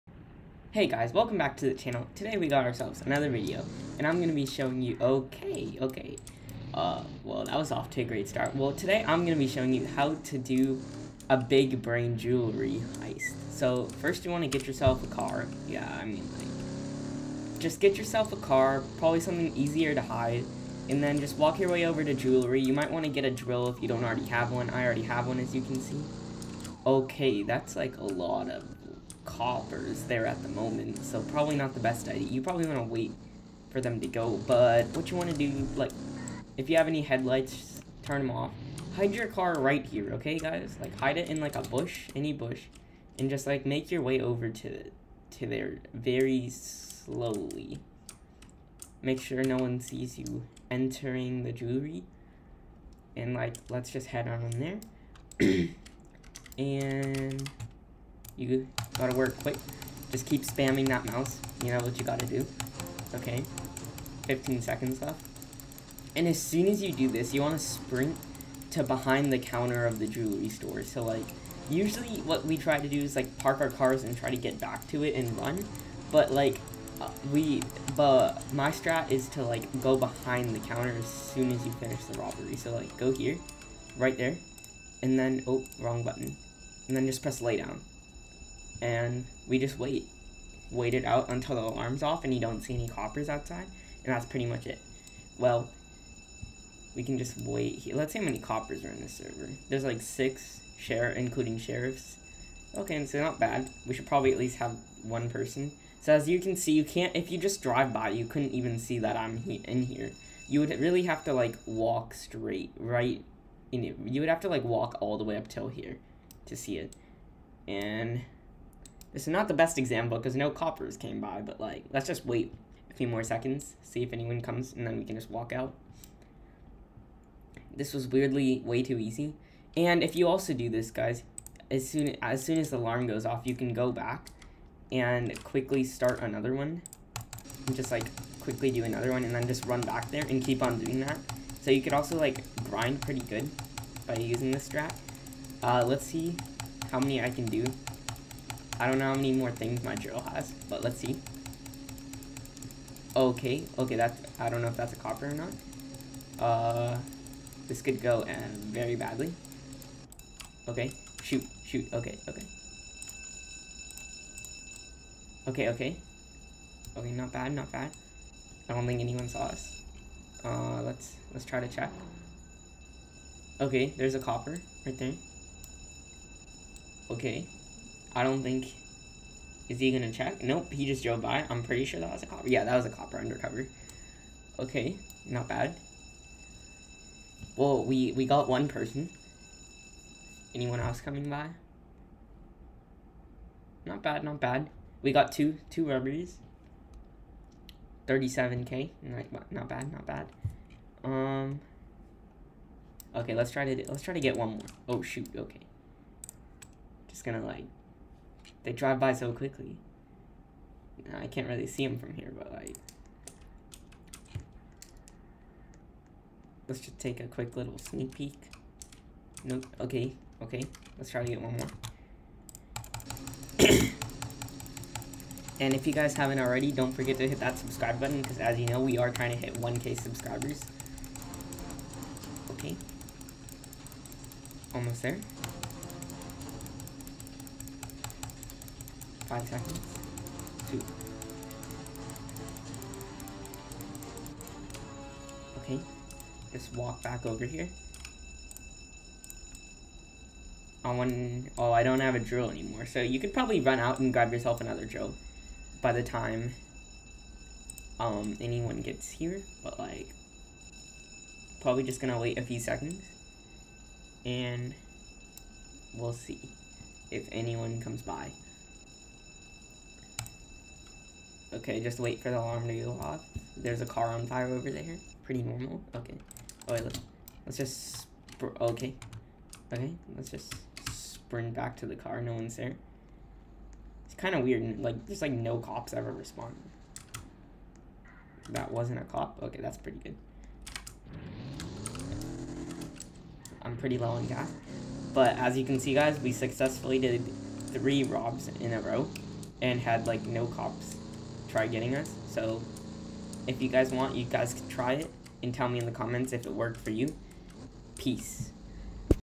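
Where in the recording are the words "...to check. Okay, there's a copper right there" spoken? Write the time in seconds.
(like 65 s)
171 s.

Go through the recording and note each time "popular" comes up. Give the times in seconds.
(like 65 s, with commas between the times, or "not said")
not said.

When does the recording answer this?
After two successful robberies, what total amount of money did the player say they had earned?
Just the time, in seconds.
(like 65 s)
198 s.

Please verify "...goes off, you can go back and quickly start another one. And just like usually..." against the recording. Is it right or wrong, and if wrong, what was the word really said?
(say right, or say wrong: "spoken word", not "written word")
wrong: "quickly", not "usually".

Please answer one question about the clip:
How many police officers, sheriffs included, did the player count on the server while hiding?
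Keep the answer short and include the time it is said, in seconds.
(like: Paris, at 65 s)
Six, at 100 s.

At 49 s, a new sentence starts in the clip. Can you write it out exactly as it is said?
Make sure no one sees you entering the jewelry, and, like, let's just head on in there.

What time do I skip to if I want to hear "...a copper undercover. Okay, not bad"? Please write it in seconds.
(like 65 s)
182 s.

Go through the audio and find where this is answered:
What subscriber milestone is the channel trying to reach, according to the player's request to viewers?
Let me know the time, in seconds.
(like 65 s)
229 s.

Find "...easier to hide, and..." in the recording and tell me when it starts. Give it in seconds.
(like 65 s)
19 s.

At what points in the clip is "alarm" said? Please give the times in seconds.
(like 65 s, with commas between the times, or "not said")
91 s, 132 s, 272 s.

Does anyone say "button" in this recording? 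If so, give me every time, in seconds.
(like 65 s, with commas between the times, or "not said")
86 s, 227 s.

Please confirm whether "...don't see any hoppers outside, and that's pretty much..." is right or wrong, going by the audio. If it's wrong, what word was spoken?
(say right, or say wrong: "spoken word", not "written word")
wrong: "coppers", not "hoppers".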